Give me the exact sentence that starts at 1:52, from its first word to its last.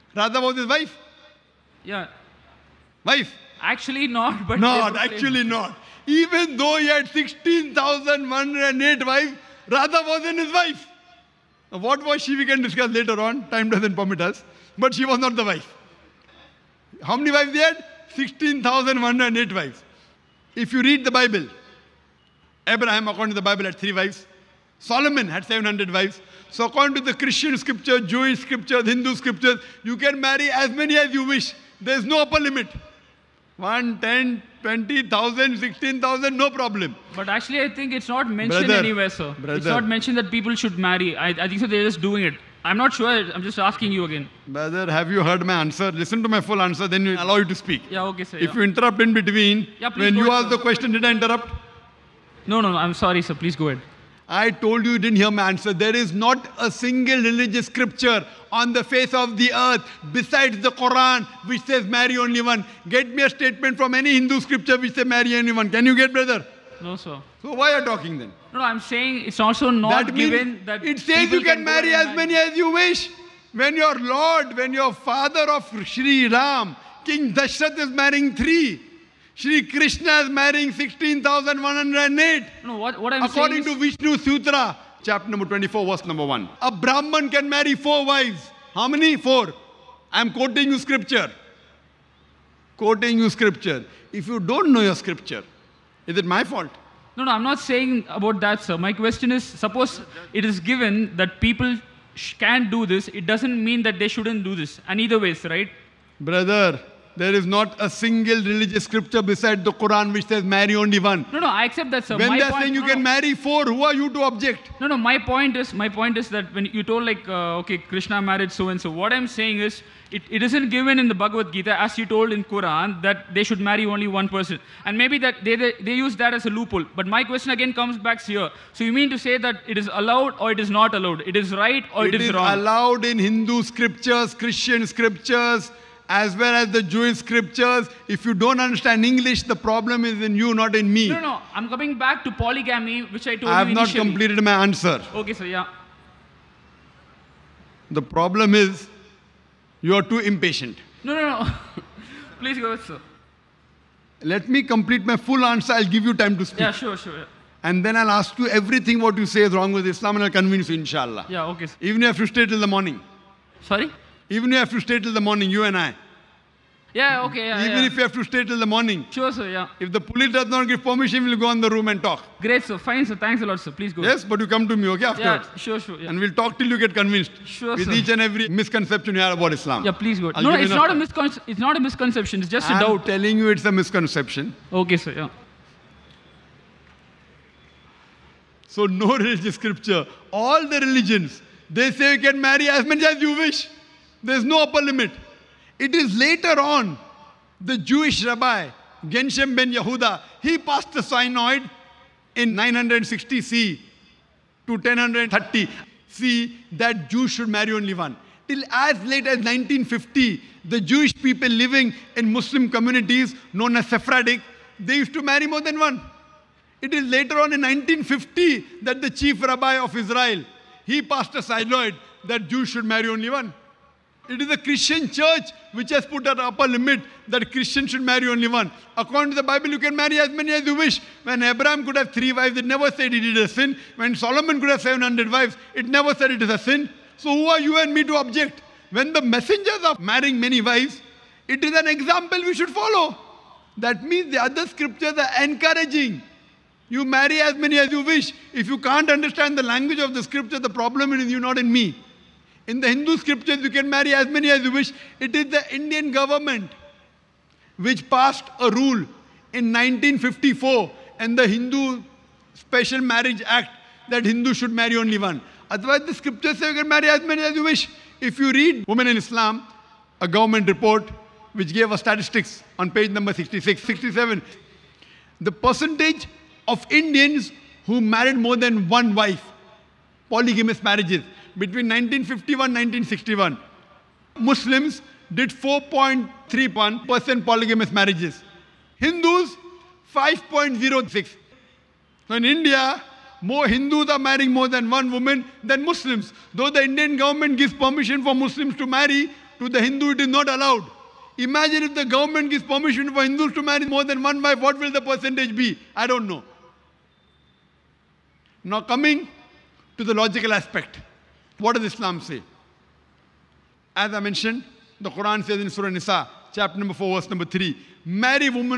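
When my they're point, saying you no, can no.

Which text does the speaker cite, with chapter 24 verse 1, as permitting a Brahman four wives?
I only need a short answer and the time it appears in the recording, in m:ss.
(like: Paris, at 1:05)
Vishnu Sutra, at 1:23.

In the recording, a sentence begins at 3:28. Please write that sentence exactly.
Till as late as 1950, the Jewish people living in Muslim communities known as Sephardic, they used to marry more than one.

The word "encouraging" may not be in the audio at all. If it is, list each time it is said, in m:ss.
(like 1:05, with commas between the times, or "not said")
4:05.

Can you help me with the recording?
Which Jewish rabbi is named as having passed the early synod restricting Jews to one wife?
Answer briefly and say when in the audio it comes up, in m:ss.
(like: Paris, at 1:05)
Gershom ben Yehuda, at 3:19.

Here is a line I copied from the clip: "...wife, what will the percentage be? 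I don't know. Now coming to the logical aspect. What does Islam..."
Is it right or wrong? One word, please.
right.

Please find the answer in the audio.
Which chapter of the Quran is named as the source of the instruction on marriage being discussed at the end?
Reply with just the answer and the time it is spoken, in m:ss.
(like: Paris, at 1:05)
Surah Nisa, at 5:15.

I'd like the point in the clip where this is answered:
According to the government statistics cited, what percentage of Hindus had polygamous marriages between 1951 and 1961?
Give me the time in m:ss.
4:50.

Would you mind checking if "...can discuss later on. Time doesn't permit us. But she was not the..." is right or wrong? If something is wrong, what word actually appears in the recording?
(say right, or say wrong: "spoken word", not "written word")
right.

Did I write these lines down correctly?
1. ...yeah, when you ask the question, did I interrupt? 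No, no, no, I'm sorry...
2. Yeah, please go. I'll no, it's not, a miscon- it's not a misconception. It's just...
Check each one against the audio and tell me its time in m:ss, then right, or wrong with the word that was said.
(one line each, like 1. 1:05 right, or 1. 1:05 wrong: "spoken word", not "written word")
1. 0:49 right
2. 2:59 right.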